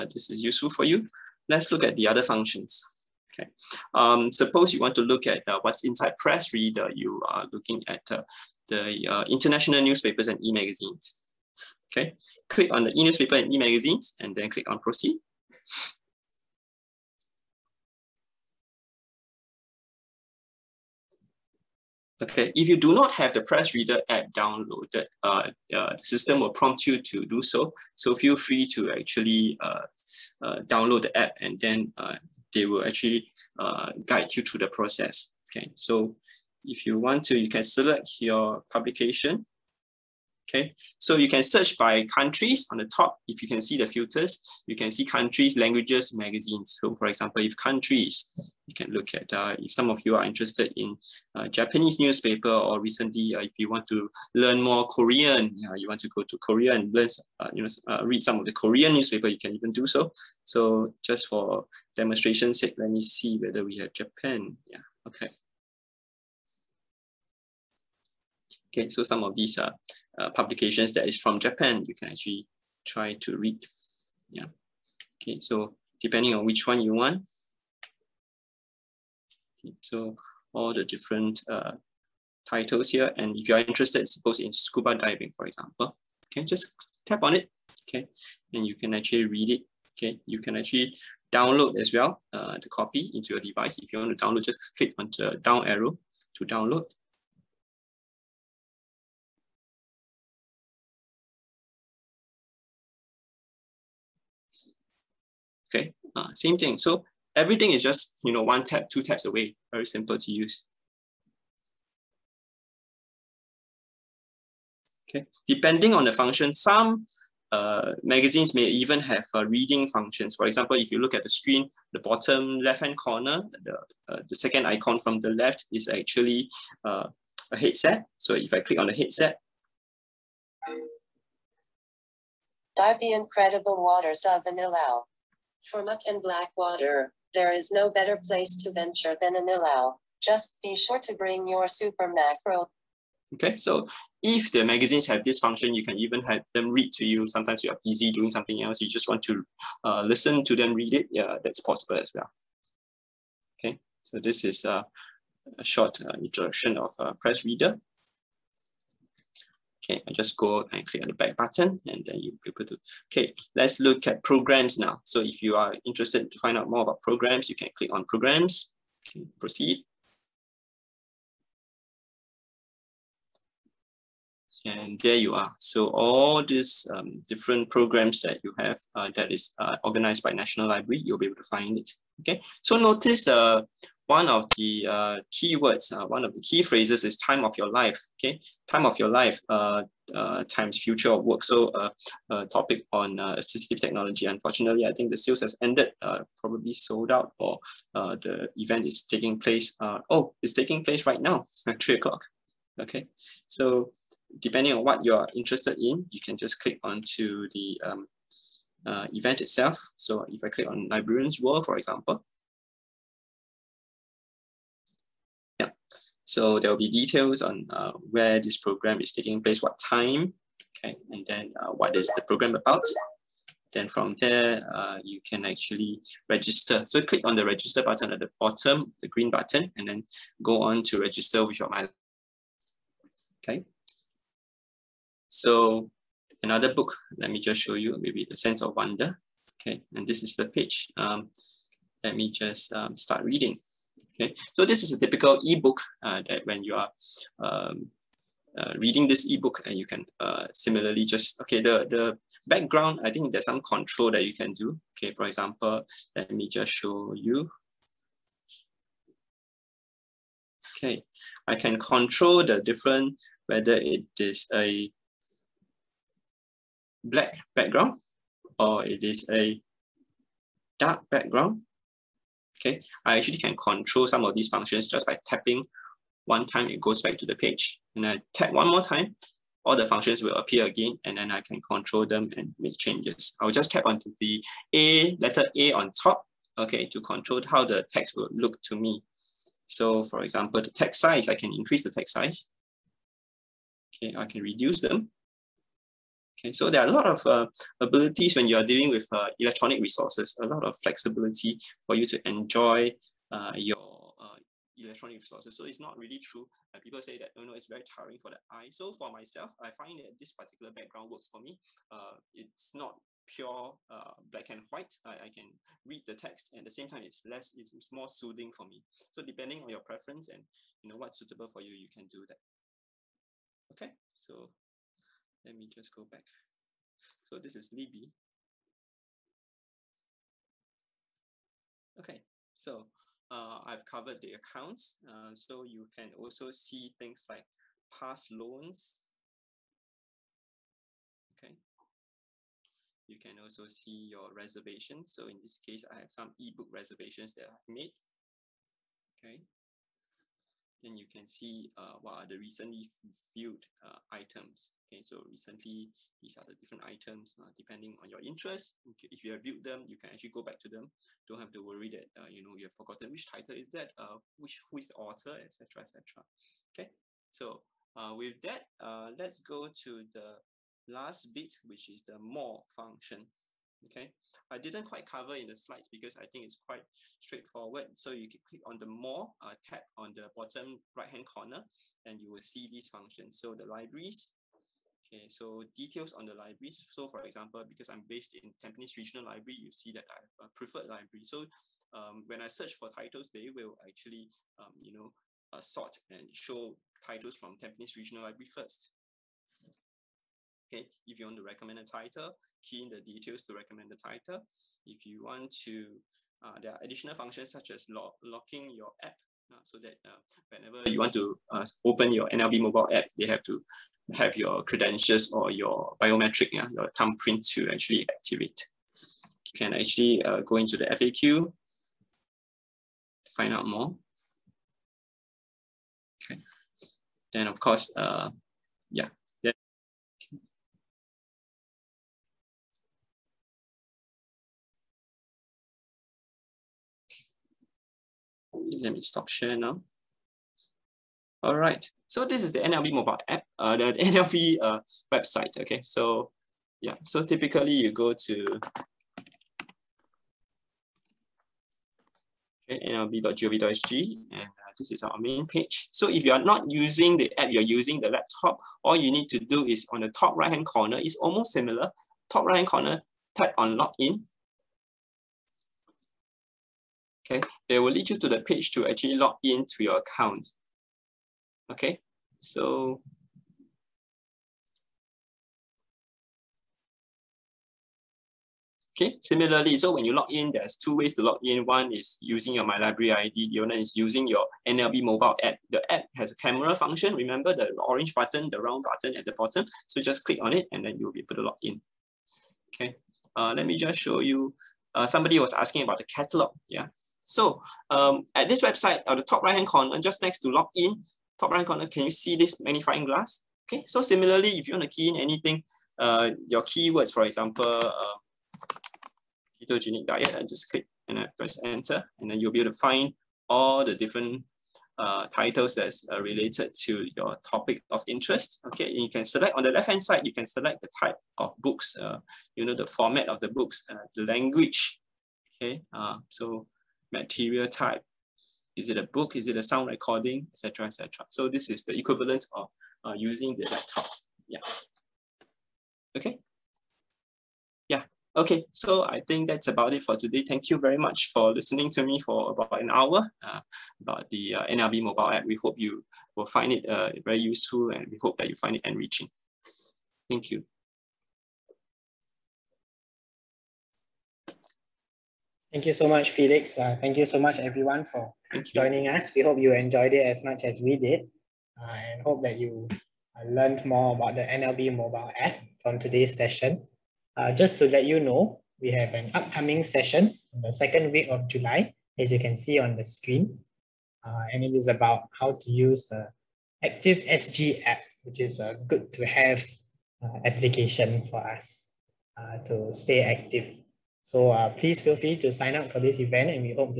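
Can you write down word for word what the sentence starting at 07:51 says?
Okay, so Okay, similarly, so when you log in, there's two ways to log in.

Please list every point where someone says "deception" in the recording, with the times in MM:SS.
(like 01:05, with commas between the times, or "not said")
not said.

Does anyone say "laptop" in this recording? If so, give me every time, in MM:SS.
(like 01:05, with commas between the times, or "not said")
07:38, 08:53.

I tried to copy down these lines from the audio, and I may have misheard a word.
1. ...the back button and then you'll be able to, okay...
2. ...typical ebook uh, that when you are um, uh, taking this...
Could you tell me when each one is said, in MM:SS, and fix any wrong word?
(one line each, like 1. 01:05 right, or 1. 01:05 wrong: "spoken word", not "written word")
1. 02:41 right
2. 04:05 wrong: "reading", not "taking".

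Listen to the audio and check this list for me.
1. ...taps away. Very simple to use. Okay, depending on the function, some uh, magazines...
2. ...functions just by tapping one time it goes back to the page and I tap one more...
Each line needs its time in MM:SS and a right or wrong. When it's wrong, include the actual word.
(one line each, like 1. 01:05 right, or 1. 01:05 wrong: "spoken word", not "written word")
1. 01:49 right
2. 04:34 right.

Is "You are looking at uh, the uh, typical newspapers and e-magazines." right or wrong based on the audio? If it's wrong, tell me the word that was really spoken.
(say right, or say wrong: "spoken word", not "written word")
wrong: "international", not "typical".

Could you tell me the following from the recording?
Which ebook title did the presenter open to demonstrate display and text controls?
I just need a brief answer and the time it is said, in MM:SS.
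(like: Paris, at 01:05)
The Sense of Wonder, at 03:58.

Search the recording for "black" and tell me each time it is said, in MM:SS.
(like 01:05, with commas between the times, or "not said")
02:16, 04:27, 05:14.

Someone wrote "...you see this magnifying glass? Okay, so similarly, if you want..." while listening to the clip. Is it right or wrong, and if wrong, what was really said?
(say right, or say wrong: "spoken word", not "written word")
right.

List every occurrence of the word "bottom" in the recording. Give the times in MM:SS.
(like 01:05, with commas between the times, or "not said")
02:01, 03:48, 06:20, 08:09.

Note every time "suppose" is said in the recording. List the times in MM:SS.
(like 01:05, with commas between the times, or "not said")
00:04, 01:24.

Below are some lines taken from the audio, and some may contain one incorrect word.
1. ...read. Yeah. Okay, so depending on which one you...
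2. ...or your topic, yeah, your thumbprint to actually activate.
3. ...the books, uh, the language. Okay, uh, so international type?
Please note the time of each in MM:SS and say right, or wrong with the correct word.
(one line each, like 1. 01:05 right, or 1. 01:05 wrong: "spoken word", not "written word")
1. 01:13 right
2. 06:55 wrong: "biometric", not "topic"
3. 08:43 wrong: "material", not "international".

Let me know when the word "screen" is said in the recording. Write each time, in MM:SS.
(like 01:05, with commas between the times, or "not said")
02:01, 09:33.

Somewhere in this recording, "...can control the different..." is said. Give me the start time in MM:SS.
04:21.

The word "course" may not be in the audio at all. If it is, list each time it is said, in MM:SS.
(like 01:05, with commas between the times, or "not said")
07:07.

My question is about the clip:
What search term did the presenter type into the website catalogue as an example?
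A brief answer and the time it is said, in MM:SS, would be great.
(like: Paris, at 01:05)
Ketogenic diet, at 08:29.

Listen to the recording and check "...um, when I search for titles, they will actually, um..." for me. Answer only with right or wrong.
right.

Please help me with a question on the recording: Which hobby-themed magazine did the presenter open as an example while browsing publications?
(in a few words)
Scuba diving.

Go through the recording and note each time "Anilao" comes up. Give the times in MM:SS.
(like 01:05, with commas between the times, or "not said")
02:14, 02:19.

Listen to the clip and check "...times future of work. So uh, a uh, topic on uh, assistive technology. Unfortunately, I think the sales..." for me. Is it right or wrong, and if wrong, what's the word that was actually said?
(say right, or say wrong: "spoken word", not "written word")
right.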